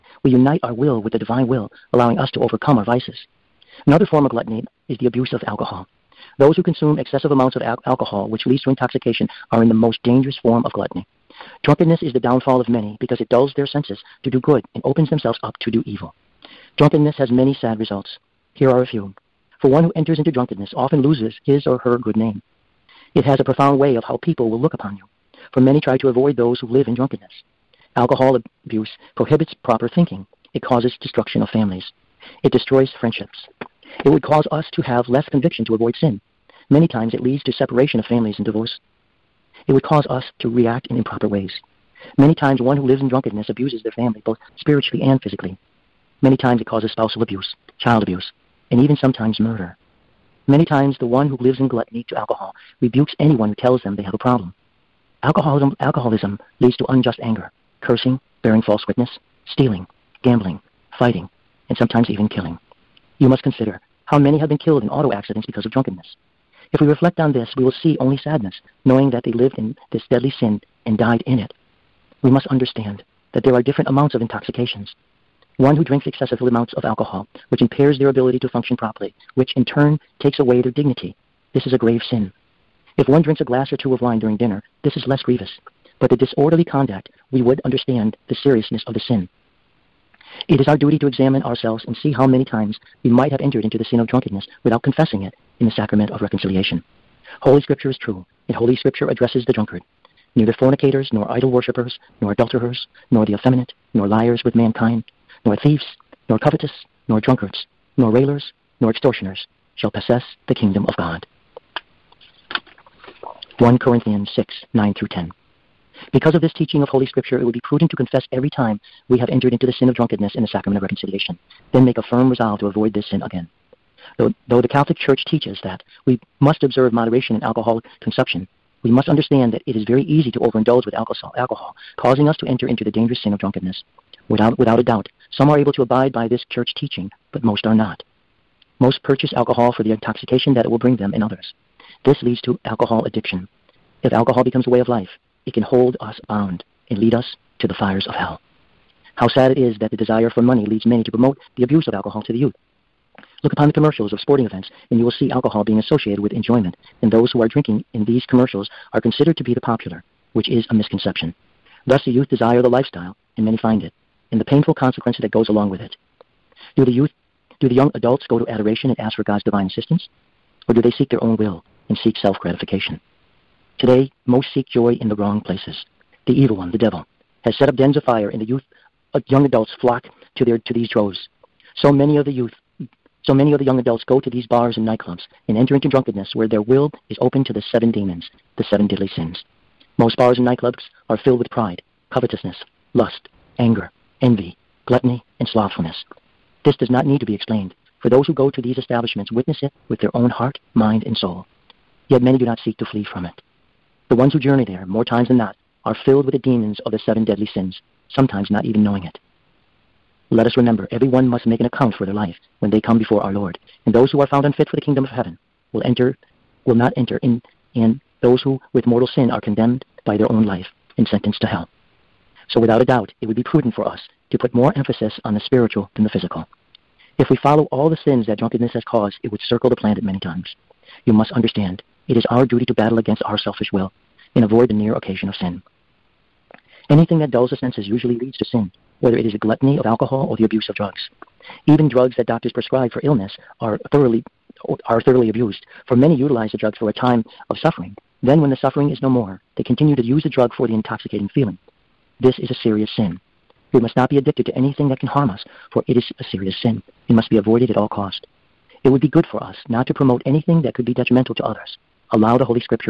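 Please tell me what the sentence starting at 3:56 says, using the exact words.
Anything that dulls the senses usually leads to sin, whether it is the gluttony of alcohol or the abuse of drugs.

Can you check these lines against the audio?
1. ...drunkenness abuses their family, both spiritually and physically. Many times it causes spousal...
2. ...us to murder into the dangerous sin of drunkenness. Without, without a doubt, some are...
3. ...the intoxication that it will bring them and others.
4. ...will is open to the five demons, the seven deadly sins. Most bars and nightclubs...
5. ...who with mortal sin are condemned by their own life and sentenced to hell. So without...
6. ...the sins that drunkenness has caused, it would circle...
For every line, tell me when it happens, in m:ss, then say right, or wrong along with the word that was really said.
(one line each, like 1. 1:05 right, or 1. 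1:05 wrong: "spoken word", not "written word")
1. 0:43 right
2. 2:12 wrong: "enter", not "murder"
3. 2:19 right
4. 3:06 wrong: "seven", not "five"
5. 3:38 right
6. 3:47 right.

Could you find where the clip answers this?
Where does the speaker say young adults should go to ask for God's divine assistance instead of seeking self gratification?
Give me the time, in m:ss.
2:48.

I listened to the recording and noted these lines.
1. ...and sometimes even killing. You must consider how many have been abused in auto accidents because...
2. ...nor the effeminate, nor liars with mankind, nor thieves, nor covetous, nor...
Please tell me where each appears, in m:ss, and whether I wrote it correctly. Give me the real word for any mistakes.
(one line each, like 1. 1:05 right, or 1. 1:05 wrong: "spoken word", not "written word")
1. 1:01 wrong: "killed", not "abused"
2. 1:43 right.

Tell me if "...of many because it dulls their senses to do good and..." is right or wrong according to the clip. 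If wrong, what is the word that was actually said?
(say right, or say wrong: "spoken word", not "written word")
right.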